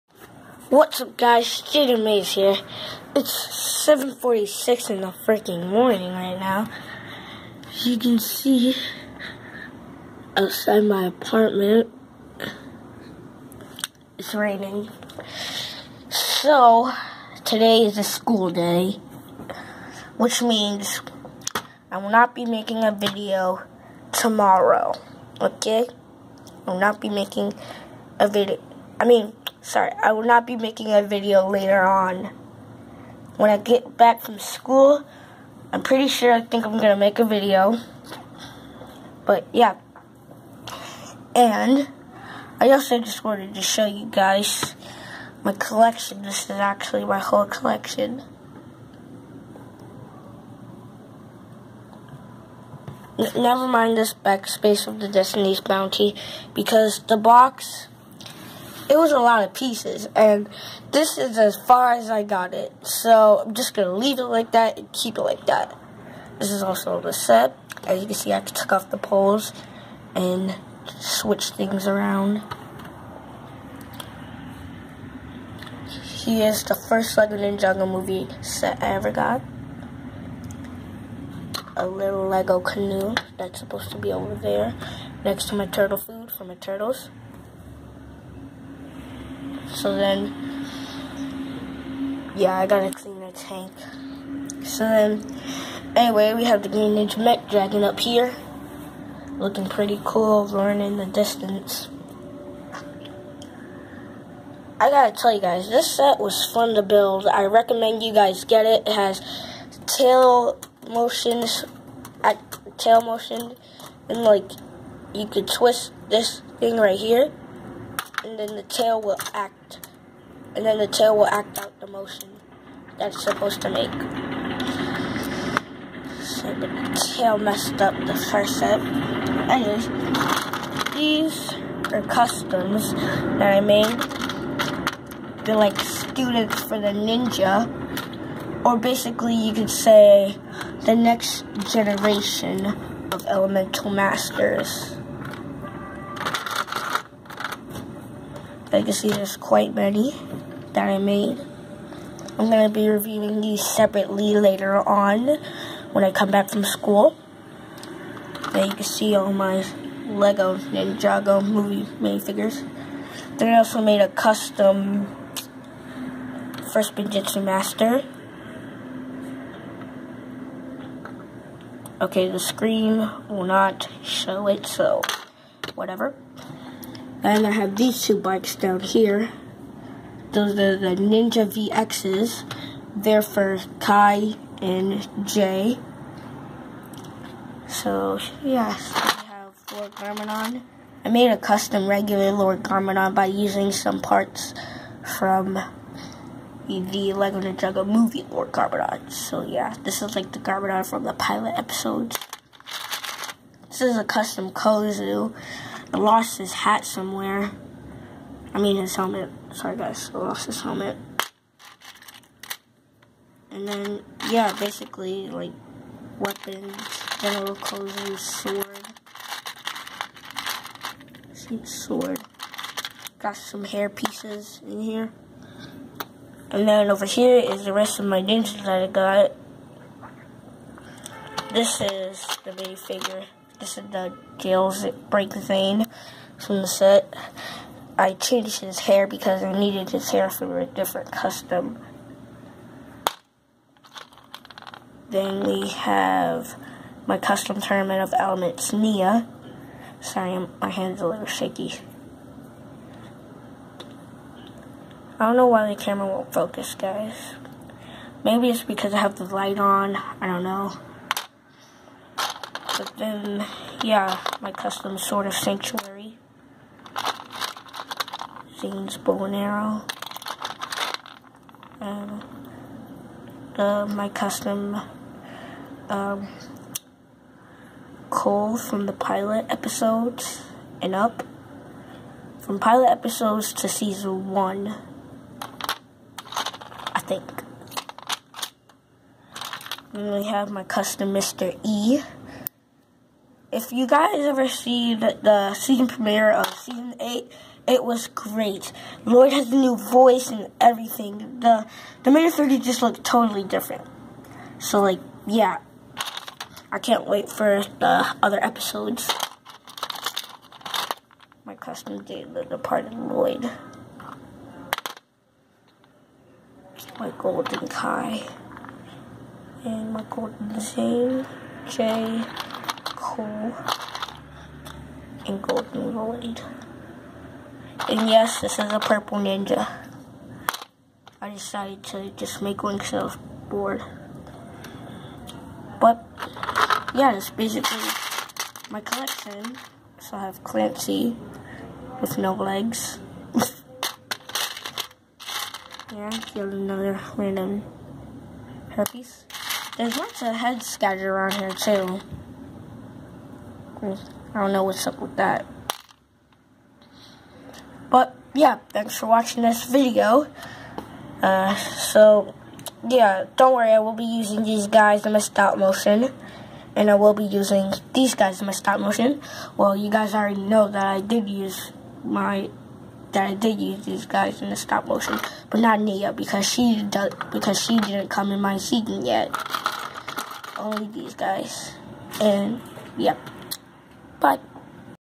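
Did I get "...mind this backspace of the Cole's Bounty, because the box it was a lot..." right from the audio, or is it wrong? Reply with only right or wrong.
wrong.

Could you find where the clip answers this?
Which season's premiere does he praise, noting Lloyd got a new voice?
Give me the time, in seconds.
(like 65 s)
296 s.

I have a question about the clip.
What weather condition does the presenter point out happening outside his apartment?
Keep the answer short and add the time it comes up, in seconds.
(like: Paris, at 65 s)
Raining, at 14 s.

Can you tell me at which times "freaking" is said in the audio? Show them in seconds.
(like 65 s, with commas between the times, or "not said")
5 s.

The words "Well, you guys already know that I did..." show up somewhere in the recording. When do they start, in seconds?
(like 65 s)
369 s.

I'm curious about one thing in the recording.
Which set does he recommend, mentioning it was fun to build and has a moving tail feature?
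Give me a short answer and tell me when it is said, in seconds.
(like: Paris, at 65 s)
Green Ninja Mech Dragon, at 96 s.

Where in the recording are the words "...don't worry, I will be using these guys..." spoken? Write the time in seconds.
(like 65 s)
363 s.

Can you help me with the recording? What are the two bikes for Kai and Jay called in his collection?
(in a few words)
Ninja VXs.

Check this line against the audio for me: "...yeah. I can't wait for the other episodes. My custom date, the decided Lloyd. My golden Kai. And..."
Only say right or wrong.
wrong.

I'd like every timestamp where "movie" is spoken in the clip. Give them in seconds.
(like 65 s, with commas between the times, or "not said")
77 s, 161 s, 197 s.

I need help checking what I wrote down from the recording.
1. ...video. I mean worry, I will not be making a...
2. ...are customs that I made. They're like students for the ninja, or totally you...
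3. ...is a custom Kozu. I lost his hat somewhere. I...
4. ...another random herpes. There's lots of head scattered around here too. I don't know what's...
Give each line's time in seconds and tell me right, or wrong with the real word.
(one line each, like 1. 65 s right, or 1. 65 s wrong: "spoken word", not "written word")
1. 28 s wrong: "sorry", not "worry"
2. 131 s wrong: "basically", not "totally"
3. 203 s right
4. 346 s right.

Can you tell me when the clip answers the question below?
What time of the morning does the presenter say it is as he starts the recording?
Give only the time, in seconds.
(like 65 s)
3 s.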